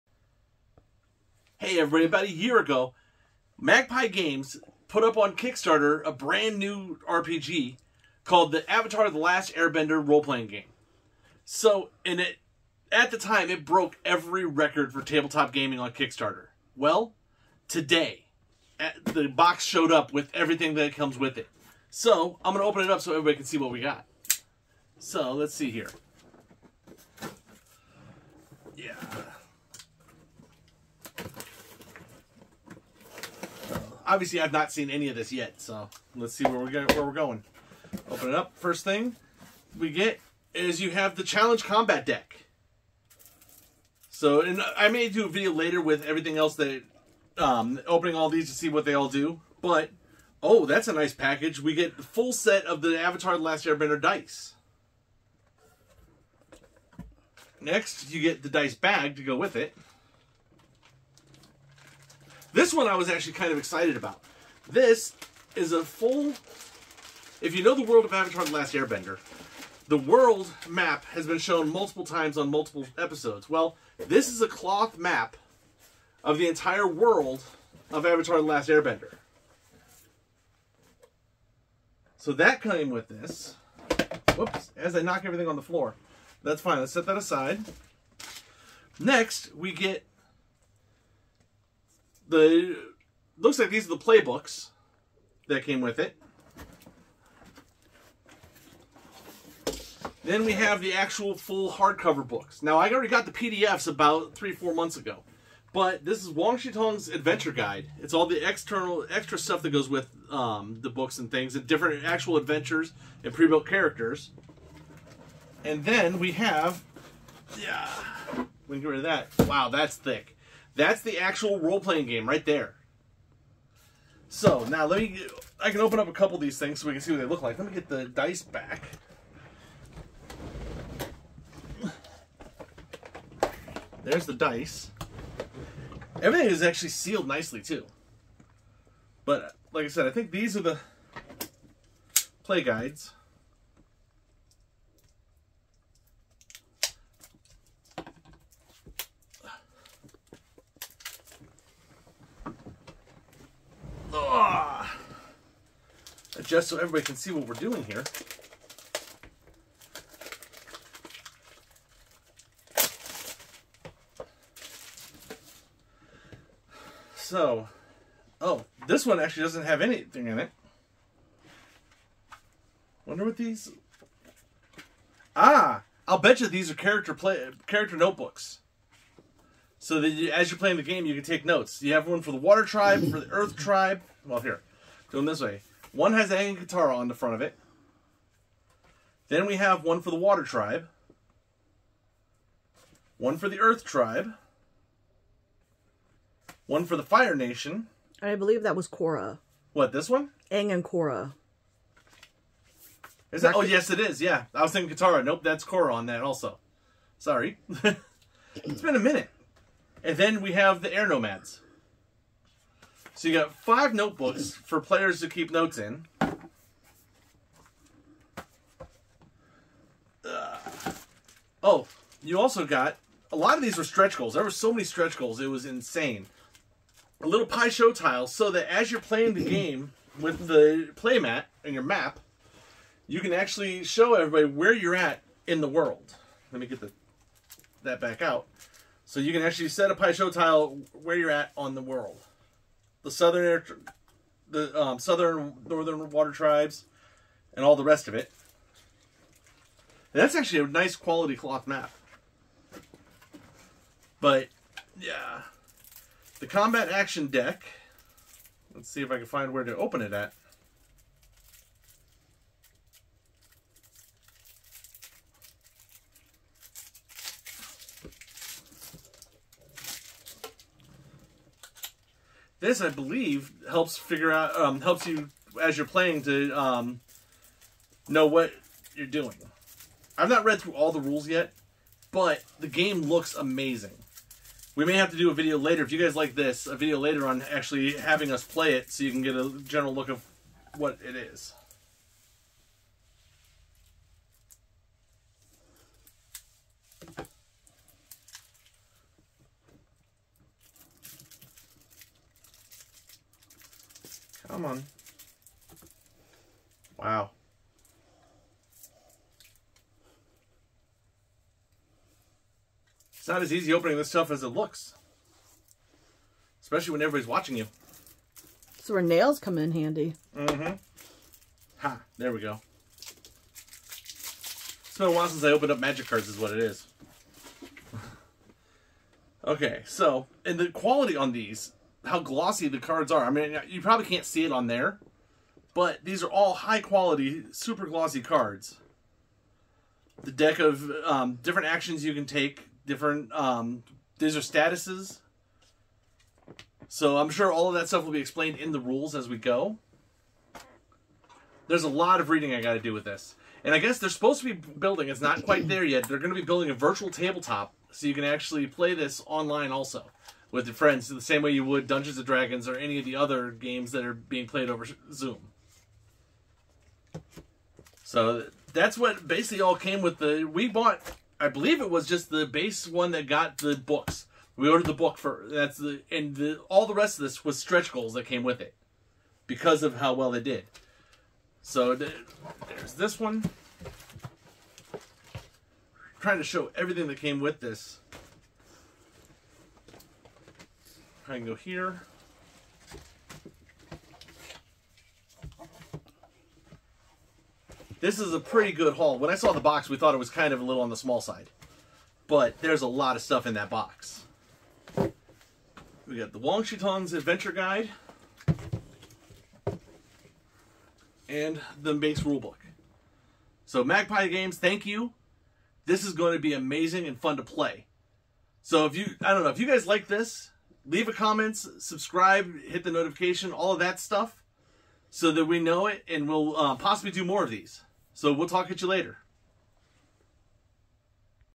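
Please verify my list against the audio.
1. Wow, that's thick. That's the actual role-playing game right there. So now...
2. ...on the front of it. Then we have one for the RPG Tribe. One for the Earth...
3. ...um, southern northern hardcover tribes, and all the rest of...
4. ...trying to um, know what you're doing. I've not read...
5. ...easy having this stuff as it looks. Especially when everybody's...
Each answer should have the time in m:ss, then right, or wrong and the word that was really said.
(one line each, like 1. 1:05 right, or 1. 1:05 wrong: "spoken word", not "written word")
1. 1:59 right
2. 3:06 wrong: "Water", not "RPG"
3. 4:04 wrong: "water", not "hardcover"
4. 4:35 wrong: "playing", not "trying"
5. 5:13 wrong: "opening", not "having".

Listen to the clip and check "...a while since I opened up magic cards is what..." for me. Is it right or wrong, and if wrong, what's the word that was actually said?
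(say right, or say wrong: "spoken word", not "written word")
right.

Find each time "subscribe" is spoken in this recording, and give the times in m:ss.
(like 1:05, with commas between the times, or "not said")
7:01.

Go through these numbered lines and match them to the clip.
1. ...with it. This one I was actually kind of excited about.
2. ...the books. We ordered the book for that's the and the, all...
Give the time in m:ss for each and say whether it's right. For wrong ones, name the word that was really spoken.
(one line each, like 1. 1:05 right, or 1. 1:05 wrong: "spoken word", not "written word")
1. 0:59 right
2. 6:13 right.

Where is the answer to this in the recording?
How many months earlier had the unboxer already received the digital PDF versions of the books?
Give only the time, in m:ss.
1:44.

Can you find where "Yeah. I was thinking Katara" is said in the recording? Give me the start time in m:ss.
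3:24.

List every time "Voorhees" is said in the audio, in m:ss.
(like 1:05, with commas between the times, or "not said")
not said.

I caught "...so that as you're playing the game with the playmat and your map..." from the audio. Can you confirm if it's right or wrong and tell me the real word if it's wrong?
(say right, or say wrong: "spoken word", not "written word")
right.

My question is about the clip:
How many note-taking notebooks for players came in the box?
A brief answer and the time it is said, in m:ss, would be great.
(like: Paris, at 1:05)
5, at 3:33.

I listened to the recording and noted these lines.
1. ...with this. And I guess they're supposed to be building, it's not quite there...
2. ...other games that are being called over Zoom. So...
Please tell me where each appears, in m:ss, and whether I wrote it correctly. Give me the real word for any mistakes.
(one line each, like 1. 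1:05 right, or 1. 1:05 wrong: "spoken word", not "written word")
1. 5:52 right
2. 6:03 wrong: "played", not "called".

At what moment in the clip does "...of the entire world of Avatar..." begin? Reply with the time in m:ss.
1:16.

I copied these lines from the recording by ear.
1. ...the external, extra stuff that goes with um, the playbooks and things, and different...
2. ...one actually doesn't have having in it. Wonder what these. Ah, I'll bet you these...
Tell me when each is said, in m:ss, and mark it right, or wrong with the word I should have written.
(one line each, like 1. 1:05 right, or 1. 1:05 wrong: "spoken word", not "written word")
1. 1:48 wrong: "books", not "playbooks"
2. 2:49 wrong: "anything", not "having".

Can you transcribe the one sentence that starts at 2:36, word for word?
just so everybody can see what we're doing here.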